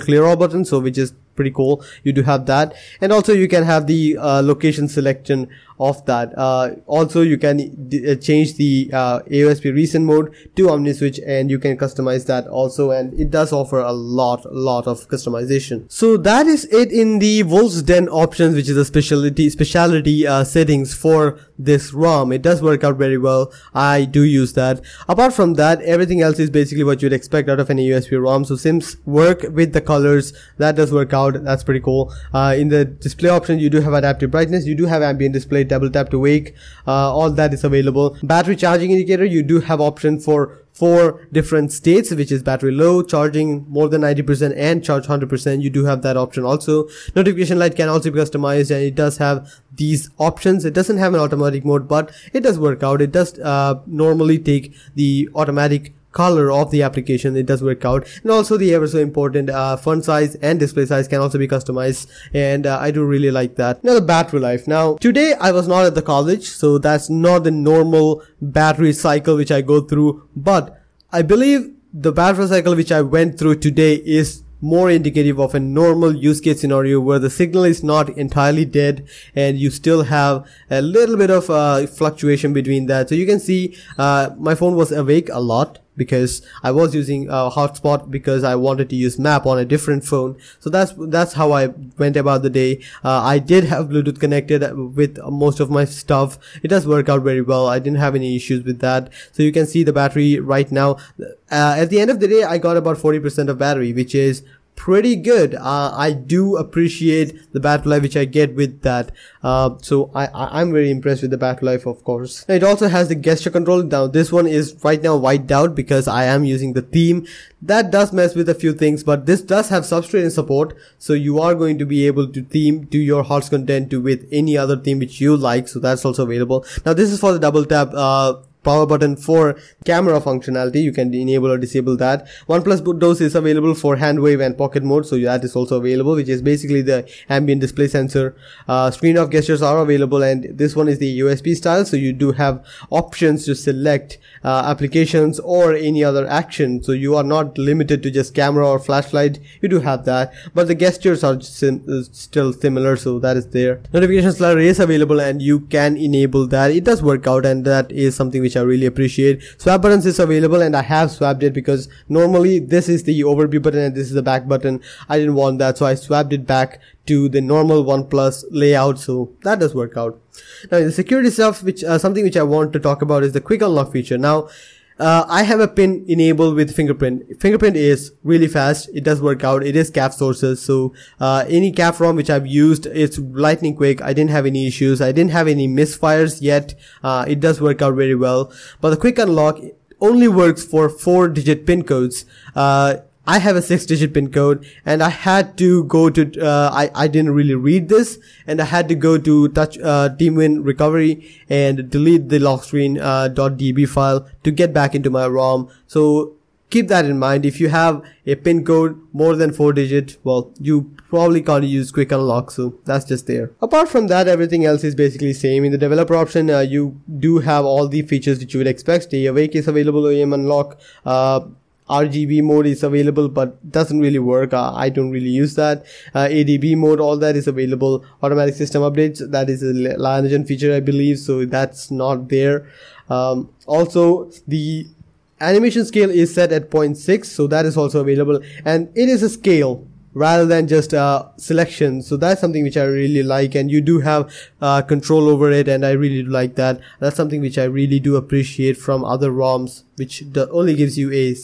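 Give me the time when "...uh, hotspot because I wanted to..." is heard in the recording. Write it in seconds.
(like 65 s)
87 s.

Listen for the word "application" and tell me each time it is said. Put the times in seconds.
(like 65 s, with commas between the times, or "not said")
56 s, 144 s.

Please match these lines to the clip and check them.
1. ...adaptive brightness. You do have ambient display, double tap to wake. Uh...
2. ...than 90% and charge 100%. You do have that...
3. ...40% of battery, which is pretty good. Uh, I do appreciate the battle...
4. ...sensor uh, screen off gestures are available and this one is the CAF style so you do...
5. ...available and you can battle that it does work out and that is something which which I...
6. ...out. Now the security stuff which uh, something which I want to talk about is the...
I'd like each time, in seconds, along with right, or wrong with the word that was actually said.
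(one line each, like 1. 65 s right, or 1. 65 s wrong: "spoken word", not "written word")
1. 33 s right
2. 43 s right
3. 102 s right
4. 137 s wrong: "AOSP", not "CAF"
5. 154 s wrong: "enable", not "battle"
6. 169 s right.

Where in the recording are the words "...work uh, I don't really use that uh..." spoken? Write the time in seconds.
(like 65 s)
224 s.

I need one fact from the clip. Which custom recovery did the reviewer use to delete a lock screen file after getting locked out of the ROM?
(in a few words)
TeamWin Recovery.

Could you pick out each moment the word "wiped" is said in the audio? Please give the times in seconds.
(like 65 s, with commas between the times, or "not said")
115 s.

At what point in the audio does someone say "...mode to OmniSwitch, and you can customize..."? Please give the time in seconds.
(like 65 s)
10 s.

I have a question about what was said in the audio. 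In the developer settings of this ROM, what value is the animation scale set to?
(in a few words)
0.6.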